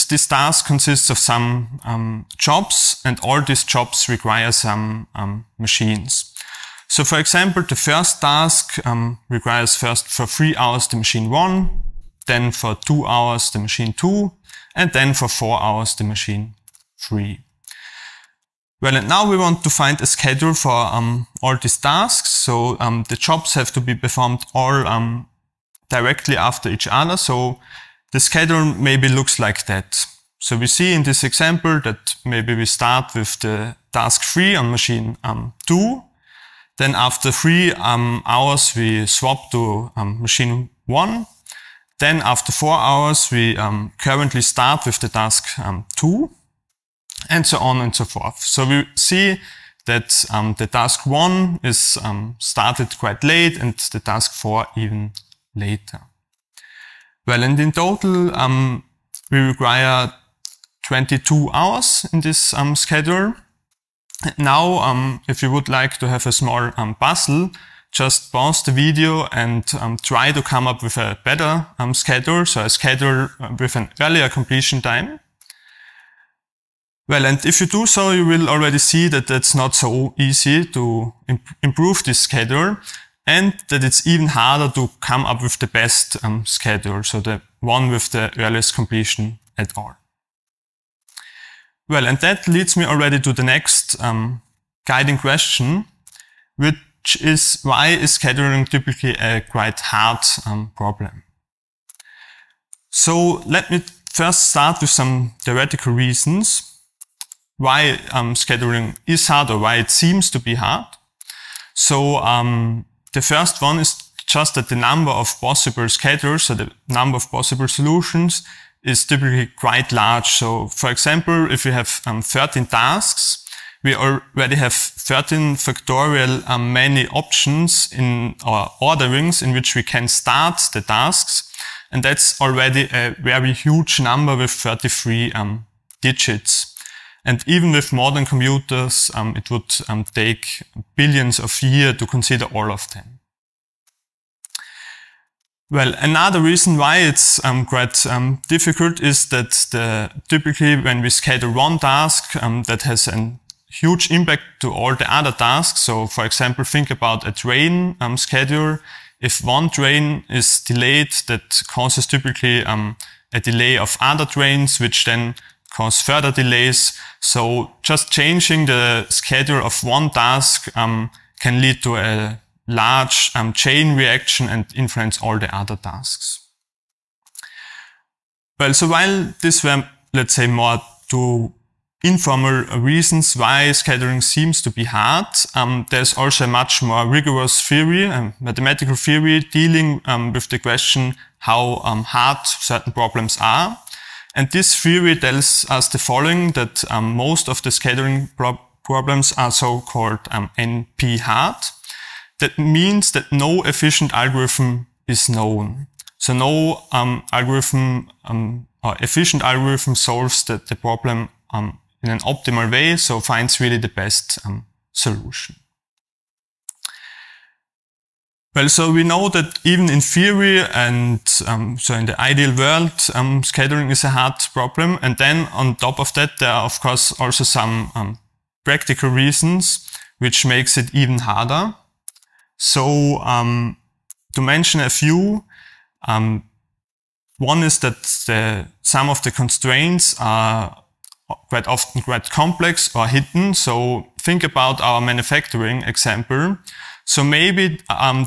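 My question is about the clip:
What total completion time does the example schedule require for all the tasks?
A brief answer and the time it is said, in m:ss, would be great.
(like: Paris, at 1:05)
22 hours, at 1:00.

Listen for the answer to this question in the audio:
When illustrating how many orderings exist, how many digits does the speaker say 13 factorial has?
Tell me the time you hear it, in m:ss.
2:14.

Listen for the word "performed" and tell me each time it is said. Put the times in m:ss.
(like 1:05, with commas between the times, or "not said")
0:23.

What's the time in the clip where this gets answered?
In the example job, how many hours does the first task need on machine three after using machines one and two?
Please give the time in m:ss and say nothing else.
0:15.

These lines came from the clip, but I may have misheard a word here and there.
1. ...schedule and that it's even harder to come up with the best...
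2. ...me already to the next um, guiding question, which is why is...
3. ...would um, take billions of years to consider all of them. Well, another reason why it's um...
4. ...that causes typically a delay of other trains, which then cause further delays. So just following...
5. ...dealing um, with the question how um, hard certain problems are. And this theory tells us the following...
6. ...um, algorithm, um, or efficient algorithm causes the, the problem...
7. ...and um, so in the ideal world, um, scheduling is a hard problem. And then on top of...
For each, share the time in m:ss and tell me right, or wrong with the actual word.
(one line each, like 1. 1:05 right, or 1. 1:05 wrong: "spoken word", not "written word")
1. 1:22 right
2. 1:32 right
3. 2:19 right
4. 2:41 wrong: "changing", not "following"
5. 3:09 right
6. 3:26 wrong: "solves", not "causes"
7. 3:40 right.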